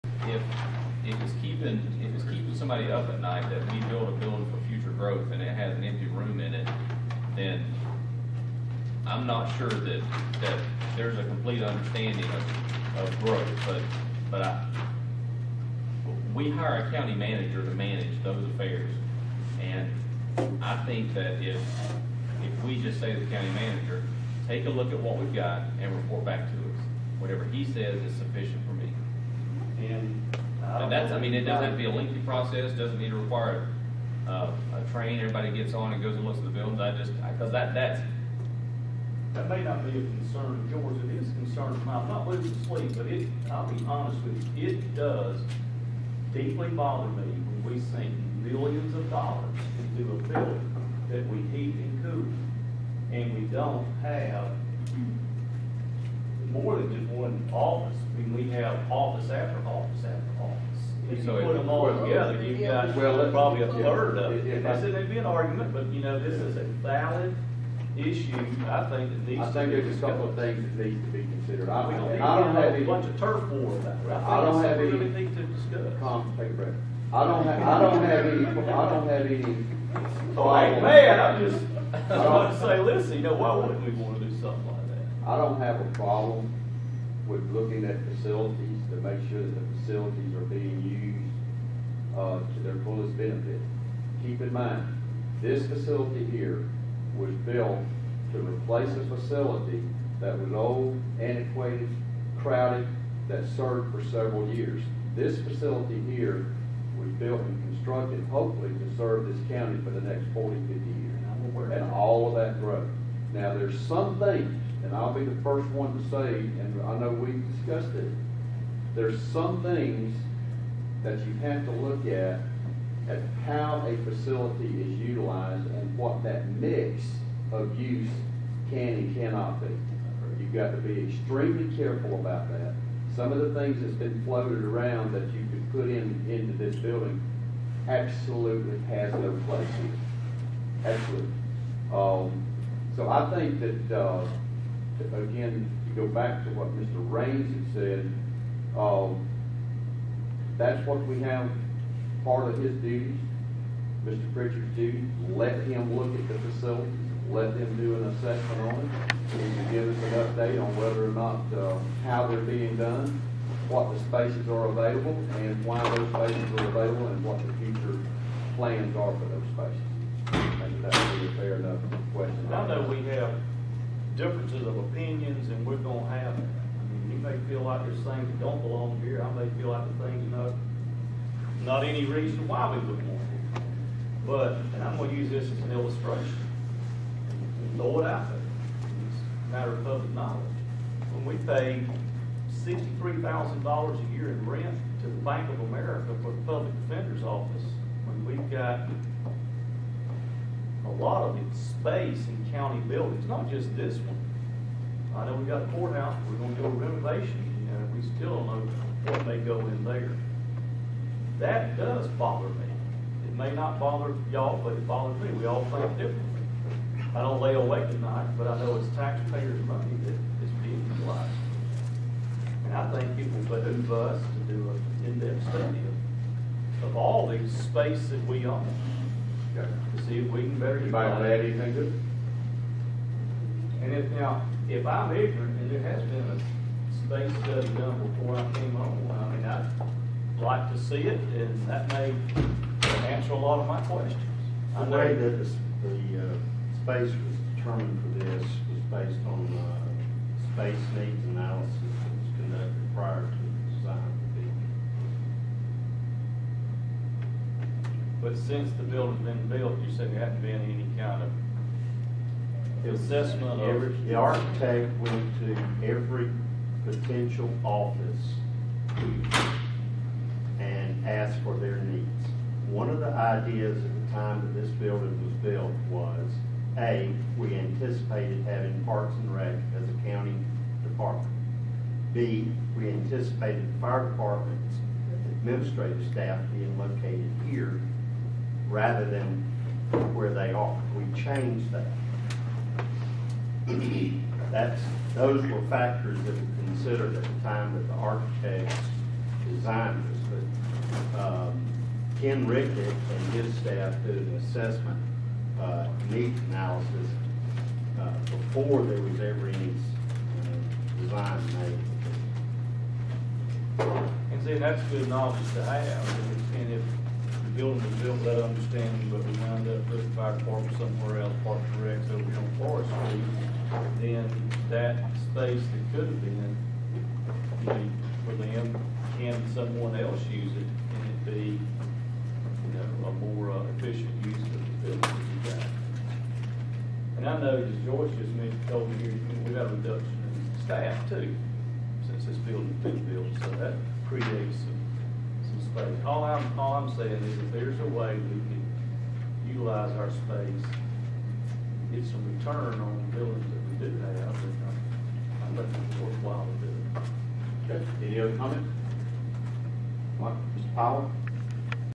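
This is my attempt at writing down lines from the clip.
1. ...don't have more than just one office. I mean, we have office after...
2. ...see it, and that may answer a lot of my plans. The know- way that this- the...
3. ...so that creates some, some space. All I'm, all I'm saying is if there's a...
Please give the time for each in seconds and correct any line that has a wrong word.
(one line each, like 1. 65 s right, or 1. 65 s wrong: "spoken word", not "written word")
1. 53 s right
2. 240 s wrong: "questions", not "plans"
3. 343 s right.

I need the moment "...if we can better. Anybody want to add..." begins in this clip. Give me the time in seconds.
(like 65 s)
230 s.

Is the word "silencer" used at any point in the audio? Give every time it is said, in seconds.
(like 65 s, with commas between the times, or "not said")
not said.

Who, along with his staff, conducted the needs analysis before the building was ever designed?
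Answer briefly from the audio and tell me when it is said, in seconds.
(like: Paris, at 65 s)
Ken Rickett, at 302 s.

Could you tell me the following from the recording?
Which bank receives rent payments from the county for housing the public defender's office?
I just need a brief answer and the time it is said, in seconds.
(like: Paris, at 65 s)
Bank of America, at 195 s.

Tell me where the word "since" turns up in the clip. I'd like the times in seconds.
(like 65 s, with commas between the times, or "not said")
258 s, 342 s.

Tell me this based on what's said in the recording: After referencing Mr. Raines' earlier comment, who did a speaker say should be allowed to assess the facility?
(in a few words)
Mr. Pritchard.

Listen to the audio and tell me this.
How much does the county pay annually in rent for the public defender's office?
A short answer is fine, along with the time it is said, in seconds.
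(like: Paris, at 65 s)
$63,000, at 192 s.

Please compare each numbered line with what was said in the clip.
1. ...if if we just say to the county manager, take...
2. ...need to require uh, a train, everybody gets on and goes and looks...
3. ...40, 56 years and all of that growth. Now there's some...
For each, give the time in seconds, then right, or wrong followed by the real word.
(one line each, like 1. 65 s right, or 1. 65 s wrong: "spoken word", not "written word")
1. 21 s right
2. 32 s right
3. 110 s wrong: "50", not "56".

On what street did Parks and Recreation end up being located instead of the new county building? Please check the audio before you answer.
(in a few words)
Forest Street.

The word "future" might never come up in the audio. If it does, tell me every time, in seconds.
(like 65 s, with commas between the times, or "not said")
4 s, 167 s.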